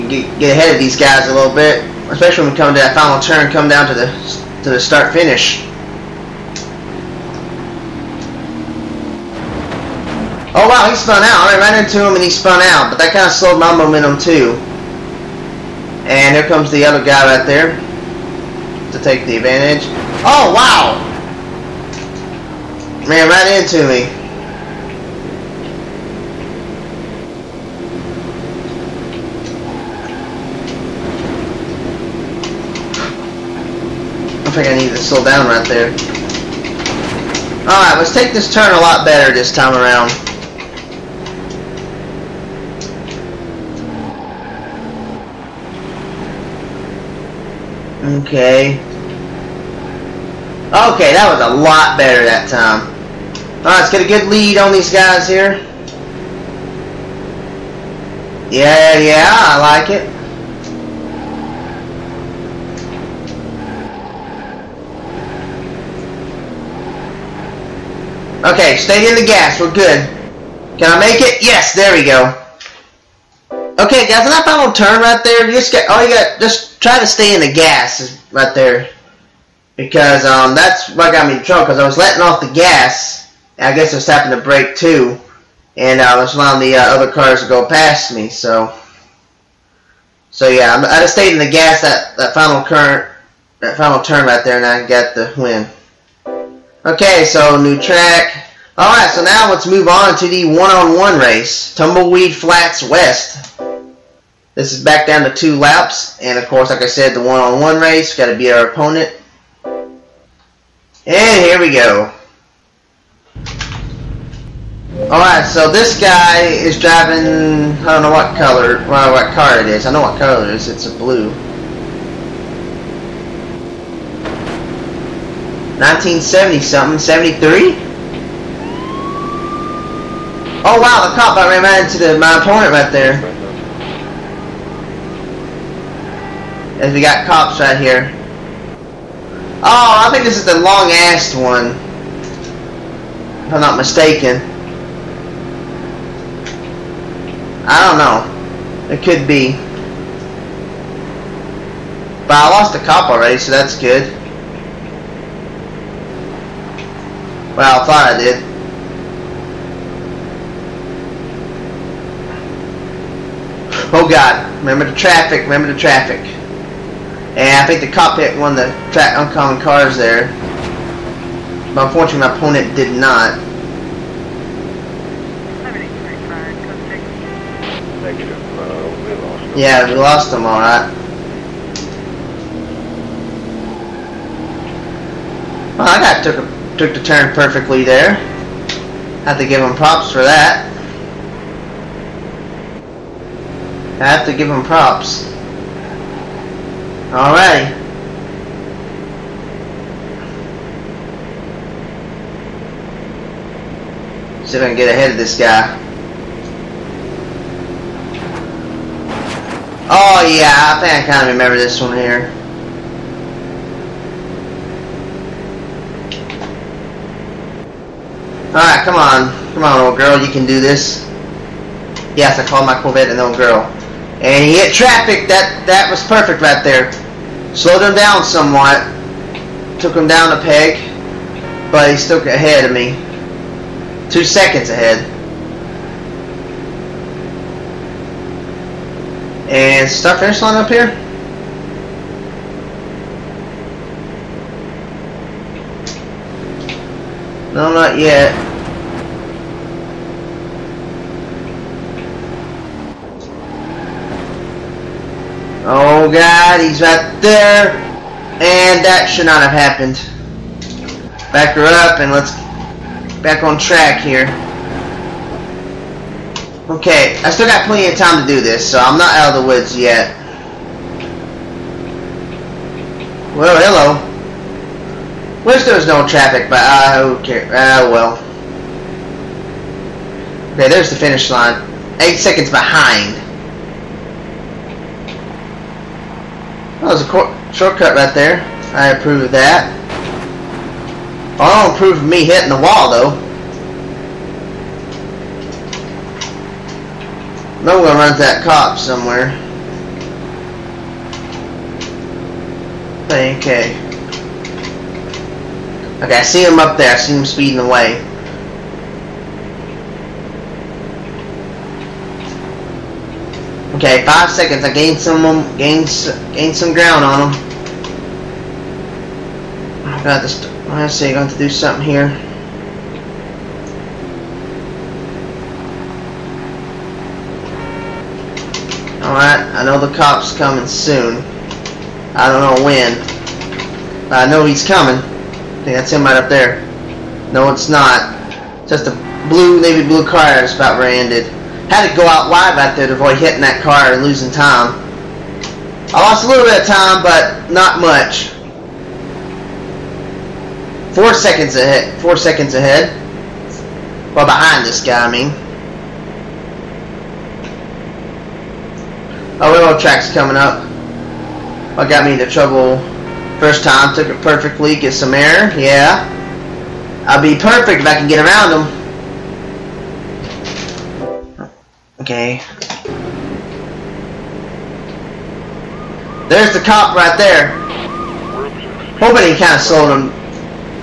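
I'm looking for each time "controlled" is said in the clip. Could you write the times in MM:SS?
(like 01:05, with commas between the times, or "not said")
not said.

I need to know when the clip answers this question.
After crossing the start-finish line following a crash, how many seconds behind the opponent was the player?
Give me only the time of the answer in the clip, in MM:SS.
04:41.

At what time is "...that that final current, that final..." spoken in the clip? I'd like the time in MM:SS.
01:31.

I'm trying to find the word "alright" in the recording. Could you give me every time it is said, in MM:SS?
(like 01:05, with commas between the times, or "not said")
00:37, 00:53, 03:00, 03:38.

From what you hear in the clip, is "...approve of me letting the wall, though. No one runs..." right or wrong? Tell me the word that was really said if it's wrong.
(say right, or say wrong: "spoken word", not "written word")
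wrong: "hitting", not "letting".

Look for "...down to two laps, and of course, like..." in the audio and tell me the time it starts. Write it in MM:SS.
01:45.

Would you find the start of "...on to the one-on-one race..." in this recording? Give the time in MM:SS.
01:39.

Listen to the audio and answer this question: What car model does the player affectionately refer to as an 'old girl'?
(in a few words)
Corvette.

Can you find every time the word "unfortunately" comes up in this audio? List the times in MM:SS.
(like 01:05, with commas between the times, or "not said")
02:51.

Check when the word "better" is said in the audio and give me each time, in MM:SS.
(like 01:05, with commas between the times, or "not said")
00:39, 00:51.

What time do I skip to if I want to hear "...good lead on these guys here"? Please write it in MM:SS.
00:54.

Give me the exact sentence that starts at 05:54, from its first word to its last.
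Well, behind this guy, I mean.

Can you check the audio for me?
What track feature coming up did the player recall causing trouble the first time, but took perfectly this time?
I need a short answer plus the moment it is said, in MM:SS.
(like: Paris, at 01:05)
Railroad track, at 05:59.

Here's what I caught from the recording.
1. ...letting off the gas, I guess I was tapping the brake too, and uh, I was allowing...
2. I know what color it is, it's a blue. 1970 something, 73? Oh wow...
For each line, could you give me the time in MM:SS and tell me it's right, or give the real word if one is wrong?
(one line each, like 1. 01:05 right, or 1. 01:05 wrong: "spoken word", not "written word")
1. 01:21 right
2. 01:59 right.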